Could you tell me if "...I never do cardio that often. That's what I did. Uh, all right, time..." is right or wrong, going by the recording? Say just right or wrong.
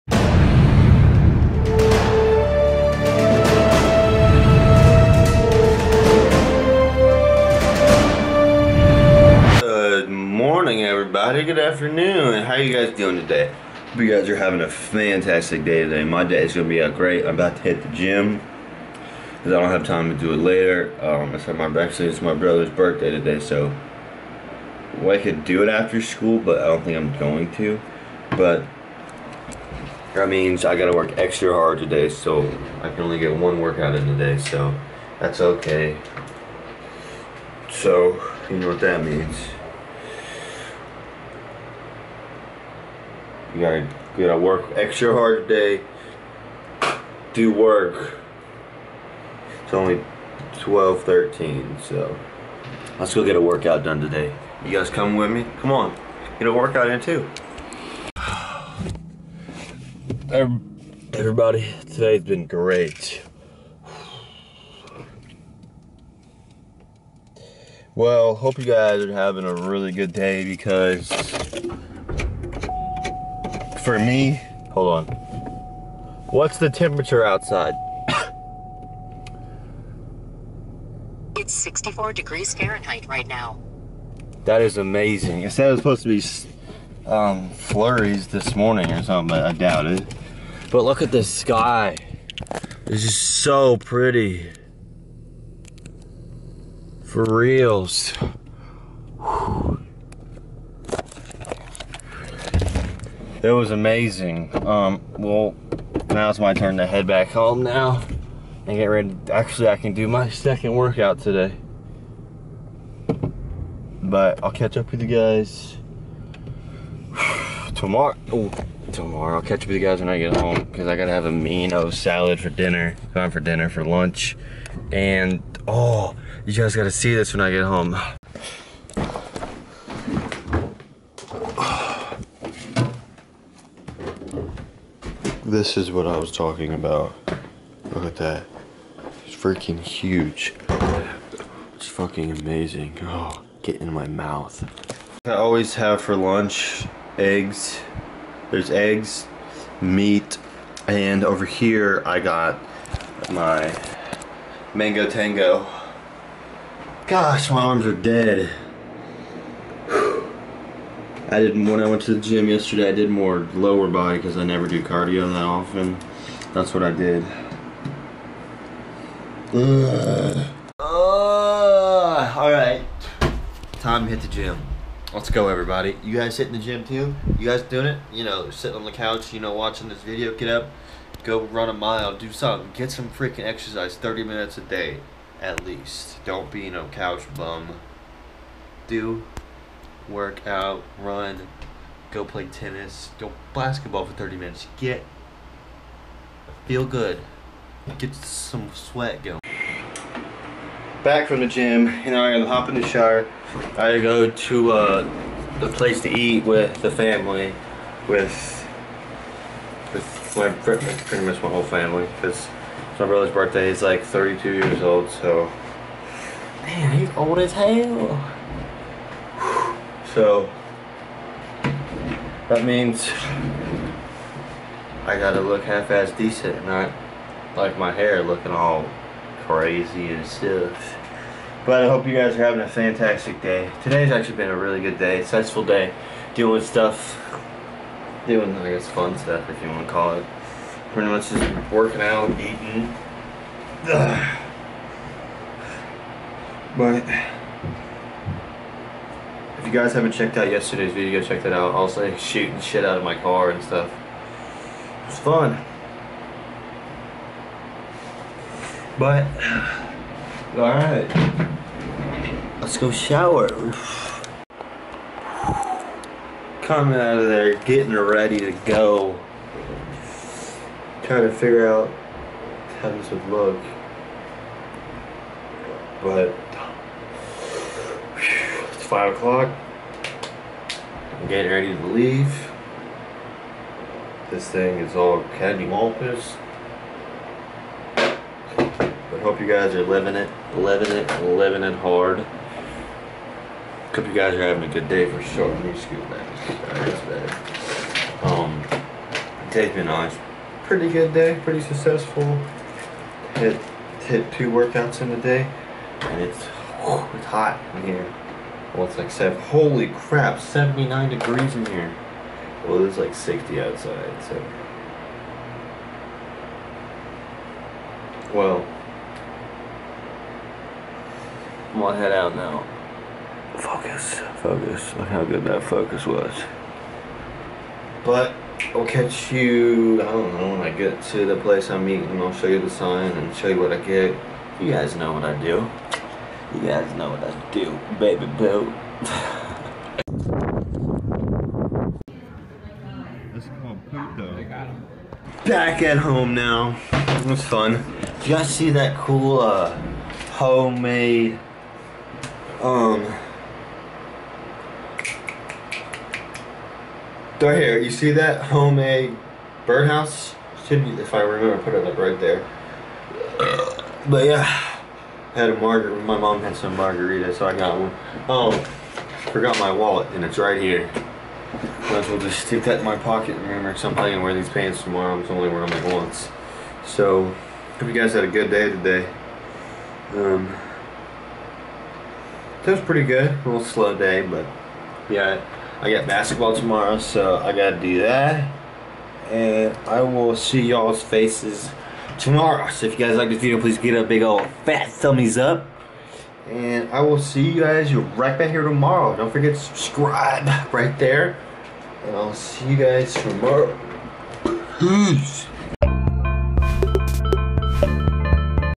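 right.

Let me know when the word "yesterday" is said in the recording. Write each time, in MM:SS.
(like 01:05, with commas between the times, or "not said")
02:42, 04:10.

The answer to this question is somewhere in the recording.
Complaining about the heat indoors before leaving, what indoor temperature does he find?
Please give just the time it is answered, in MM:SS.
05:10.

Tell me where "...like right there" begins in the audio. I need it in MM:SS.
06:01.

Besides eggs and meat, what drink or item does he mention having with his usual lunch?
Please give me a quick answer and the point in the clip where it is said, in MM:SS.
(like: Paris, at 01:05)
mango tango, at 02:34.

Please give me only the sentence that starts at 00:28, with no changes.
But that means I got to work extra hard today, so I can only get one workout in today, so that's okay.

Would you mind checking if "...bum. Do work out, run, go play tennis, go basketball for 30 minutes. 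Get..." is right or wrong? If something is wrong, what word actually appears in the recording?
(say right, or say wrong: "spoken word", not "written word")
right.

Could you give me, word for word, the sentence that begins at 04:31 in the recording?
Trying to figure out how this would look.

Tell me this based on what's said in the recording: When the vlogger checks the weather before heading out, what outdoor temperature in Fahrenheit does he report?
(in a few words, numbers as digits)
64 degrees.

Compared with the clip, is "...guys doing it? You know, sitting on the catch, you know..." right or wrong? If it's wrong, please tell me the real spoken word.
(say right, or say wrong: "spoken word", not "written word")
wrong: "couch", not "catch".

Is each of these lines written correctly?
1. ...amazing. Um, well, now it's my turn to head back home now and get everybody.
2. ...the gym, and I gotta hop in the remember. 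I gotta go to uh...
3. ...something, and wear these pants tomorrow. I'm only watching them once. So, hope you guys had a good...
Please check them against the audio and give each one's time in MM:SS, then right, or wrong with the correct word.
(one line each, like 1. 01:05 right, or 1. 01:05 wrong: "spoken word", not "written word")
1. 01:43 wrong: "ready", not "everybody"
2. 03:21 wrong: "shower", not "remember"
3. 06:13 wrong: "wearing", not "watching".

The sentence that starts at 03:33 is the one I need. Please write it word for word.
He's like 32 years old, so man, he's old as hell.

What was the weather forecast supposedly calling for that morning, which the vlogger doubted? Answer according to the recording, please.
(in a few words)
flurries.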